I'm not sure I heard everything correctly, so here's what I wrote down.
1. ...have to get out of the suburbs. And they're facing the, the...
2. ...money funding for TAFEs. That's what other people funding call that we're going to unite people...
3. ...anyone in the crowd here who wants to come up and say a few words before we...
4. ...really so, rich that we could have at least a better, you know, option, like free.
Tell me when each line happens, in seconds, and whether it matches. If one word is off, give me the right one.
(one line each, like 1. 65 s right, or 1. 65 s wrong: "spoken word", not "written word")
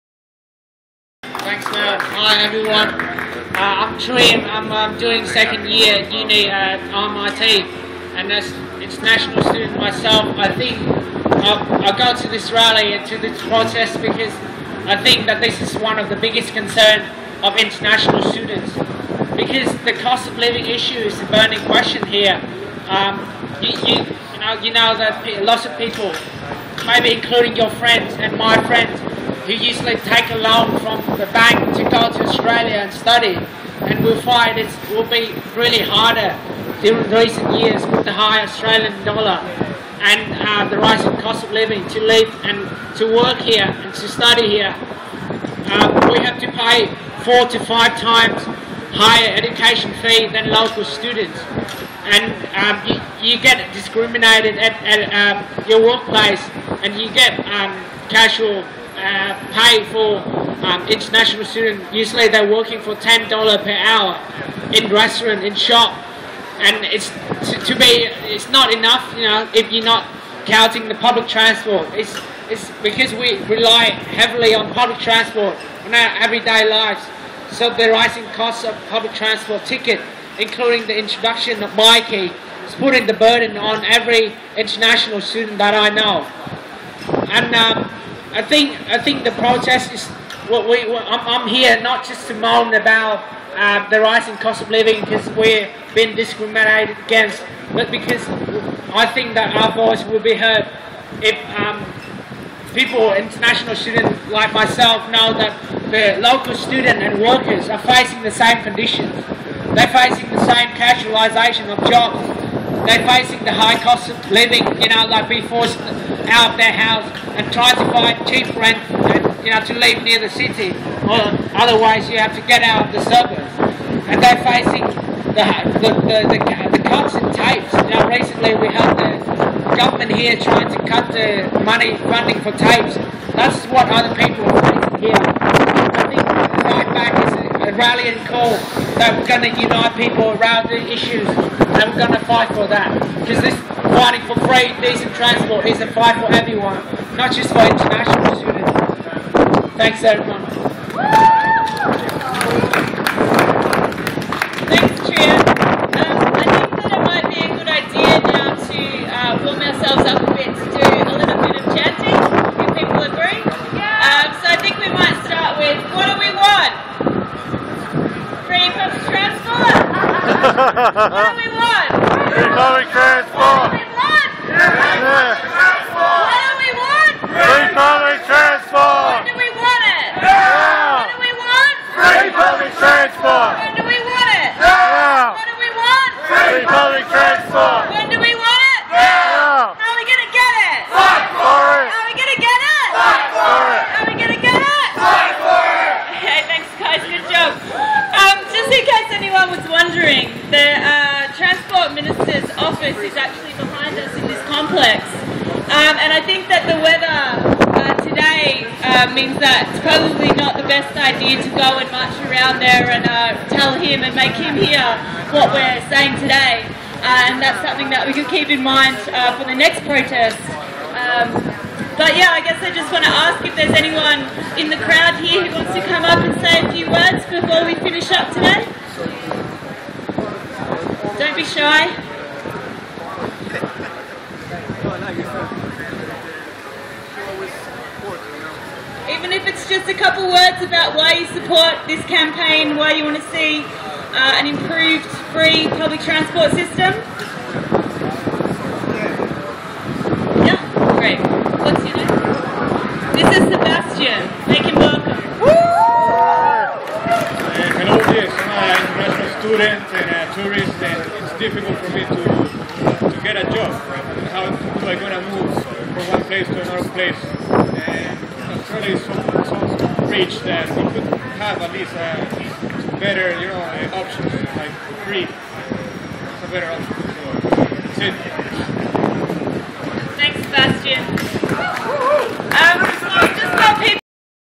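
1. 122 s right
2. 131 s wrong: "rallying", not "funding"
3. 223 s right
4. 268 s right.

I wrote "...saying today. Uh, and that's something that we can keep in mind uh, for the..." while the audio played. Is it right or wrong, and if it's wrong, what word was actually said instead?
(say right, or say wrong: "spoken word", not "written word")
right.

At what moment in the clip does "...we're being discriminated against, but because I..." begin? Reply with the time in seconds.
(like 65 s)
95 s.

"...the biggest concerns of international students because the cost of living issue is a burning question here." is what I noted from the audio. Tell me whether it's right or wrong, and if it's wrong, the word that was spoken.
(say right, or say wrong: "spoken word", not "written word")
right.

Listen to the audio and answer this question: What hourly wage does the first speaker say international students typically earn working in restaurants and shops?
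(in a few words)
$10.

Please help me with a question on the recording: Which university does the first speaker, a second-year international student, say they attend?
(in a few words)
MIT.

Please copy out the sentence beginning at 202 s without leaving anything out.
office is actually behind us in this complex.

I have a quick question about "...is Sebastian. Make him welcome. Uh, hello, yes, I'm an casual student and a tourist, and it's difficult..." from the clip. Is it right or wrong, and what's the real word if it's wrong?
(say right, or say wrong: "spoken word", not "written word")
wrong: "international", not "casual".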